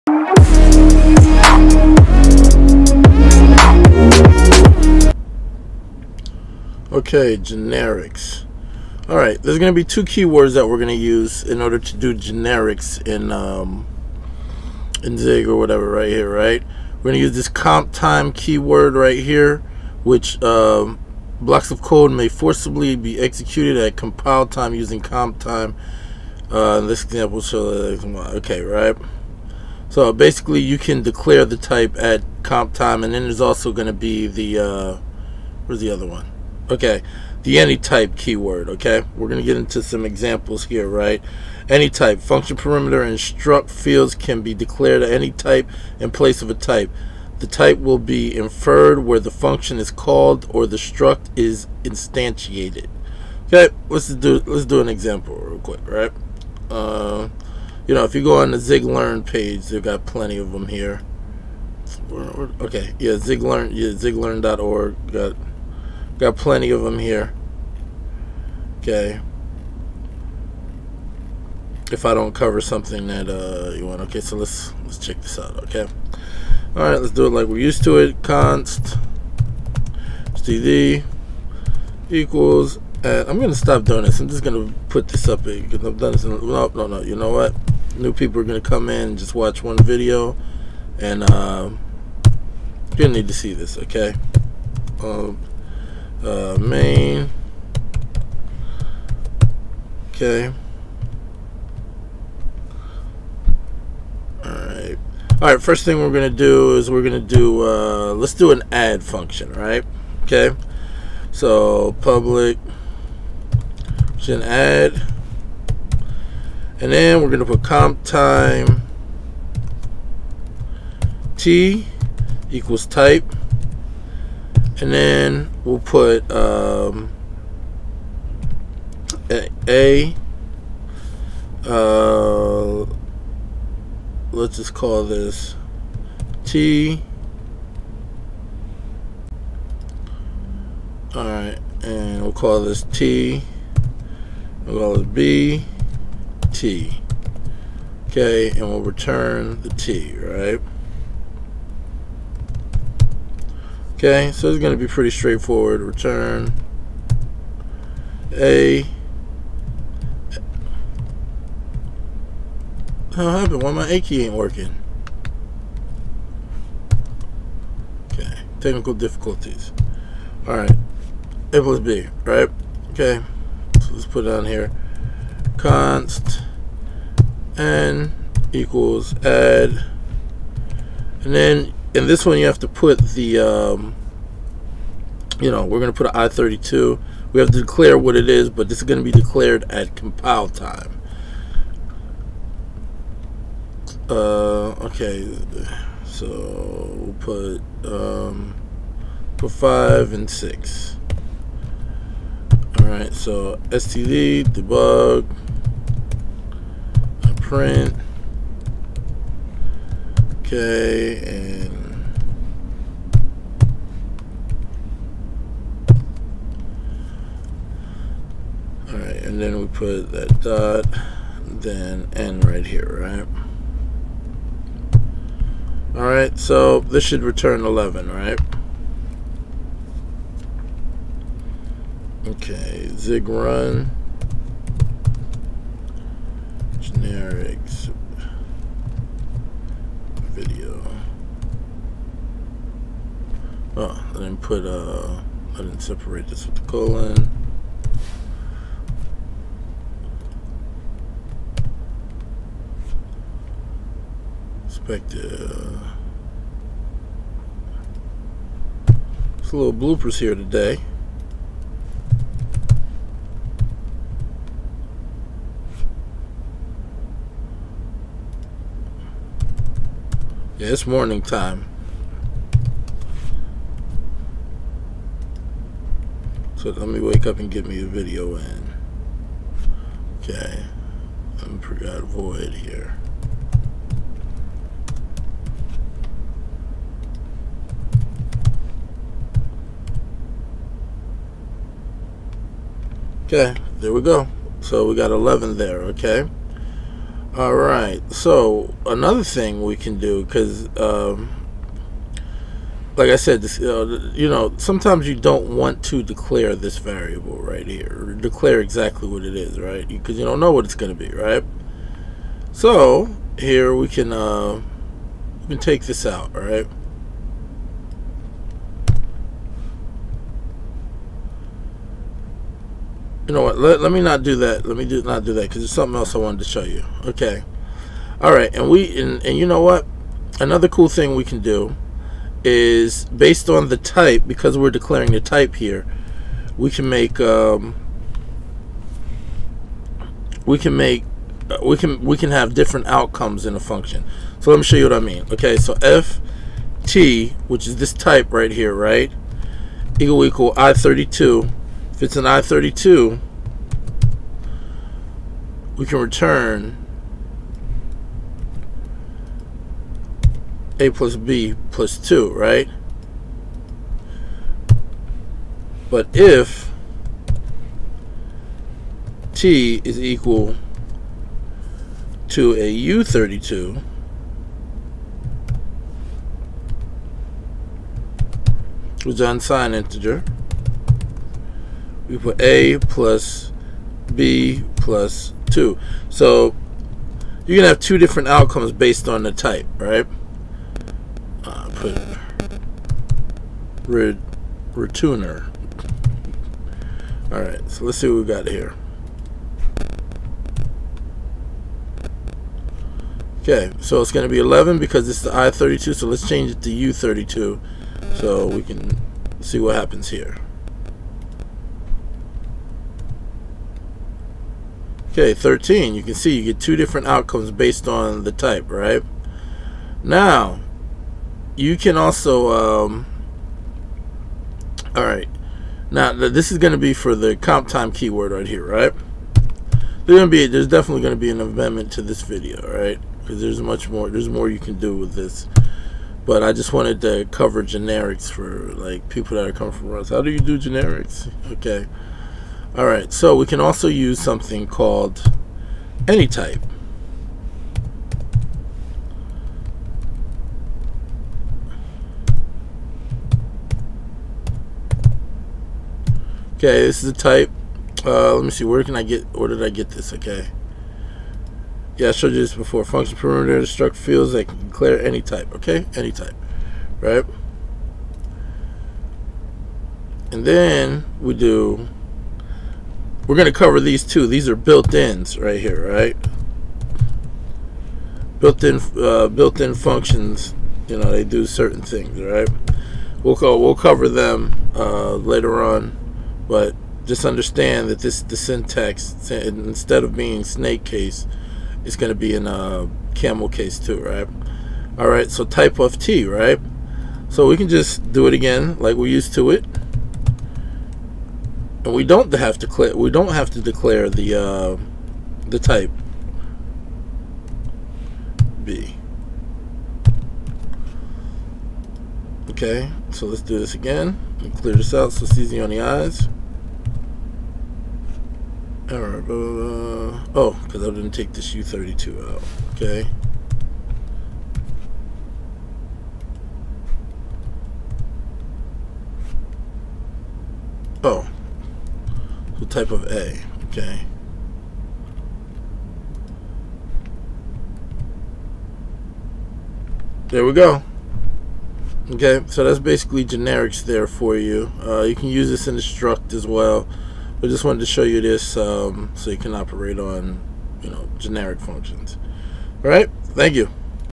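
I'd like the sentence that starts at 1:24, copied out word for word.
I'm just gonna put this up because I've done this.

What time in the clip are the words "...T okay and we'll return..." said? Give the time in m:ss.
2:26.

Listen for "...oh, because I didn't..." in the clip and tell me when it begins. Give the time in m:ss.
8:39.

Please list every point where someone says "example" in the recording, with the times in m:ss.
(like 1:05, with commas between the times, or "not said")
0:27, 0:40, 0:54.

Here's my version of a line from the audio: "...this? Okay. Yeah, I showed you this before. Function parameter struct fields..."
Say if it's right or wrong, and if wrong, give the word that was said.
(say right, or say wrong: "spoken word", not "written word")
right.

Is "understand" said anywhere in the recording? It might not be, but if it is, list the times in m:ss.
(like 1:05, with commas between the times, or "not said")
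8:07.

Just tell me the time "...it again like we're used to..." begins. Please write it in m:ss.
8:18.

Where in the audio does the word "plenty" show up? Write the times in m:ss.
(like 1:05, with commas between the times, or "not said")
1:00, 1:06.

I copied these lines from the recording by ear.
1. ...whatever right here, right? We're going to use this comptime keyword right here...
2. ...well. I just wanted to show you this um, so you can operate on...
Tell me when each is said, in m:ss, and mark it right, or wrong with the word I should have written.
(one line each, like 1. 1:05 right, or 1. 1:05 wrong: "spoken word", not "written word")
1. 0:15 right
2. 9:06 right.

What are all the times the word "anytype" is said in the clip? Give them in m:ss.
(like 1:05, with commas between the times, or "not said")
0:37, 7:26.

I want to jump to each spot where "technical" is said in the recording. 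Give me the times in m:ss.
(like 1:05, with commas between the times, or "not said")
2:48.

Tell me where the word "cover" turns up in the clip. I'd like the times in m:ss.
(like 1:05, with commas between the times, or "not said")
1:12, 7:17, 7:53, 8:03.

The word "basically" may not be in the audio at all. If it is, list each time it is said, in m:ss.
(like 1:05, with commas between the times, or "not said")
0:30, 9:02.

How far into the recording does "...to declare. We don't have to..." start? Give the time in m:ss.
8:22.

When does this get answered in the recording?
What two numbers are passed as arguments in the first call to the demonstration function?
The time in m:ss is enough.
3:19.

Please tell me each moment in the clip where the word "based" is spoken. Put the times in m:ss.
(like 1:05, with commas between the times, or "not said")
5:33, 6:28, 6:57.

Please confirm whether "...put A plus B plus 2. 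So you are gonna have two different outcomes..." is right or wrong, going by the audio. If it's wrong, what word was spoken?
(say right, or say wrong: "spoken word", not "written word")
right.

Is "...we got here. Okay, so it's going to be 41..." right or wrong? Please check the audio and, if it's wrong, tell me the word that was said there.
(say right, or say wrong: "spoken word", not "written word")
wrong: "11", not "41".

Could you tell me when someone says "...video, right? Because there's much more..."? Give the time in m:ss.
7:12.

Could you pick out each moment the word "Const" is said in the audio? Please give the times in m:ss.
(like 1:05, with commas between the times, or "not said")
1:18, 2:55.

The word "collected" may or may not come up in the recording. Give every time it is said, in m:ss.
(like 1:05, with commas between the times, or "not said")
not said.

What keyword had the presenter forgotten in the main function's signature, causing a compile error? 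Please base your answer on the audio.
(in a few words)
void.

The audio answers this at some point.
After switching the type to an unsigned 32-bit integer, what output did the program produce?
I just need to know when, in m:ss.
6:55.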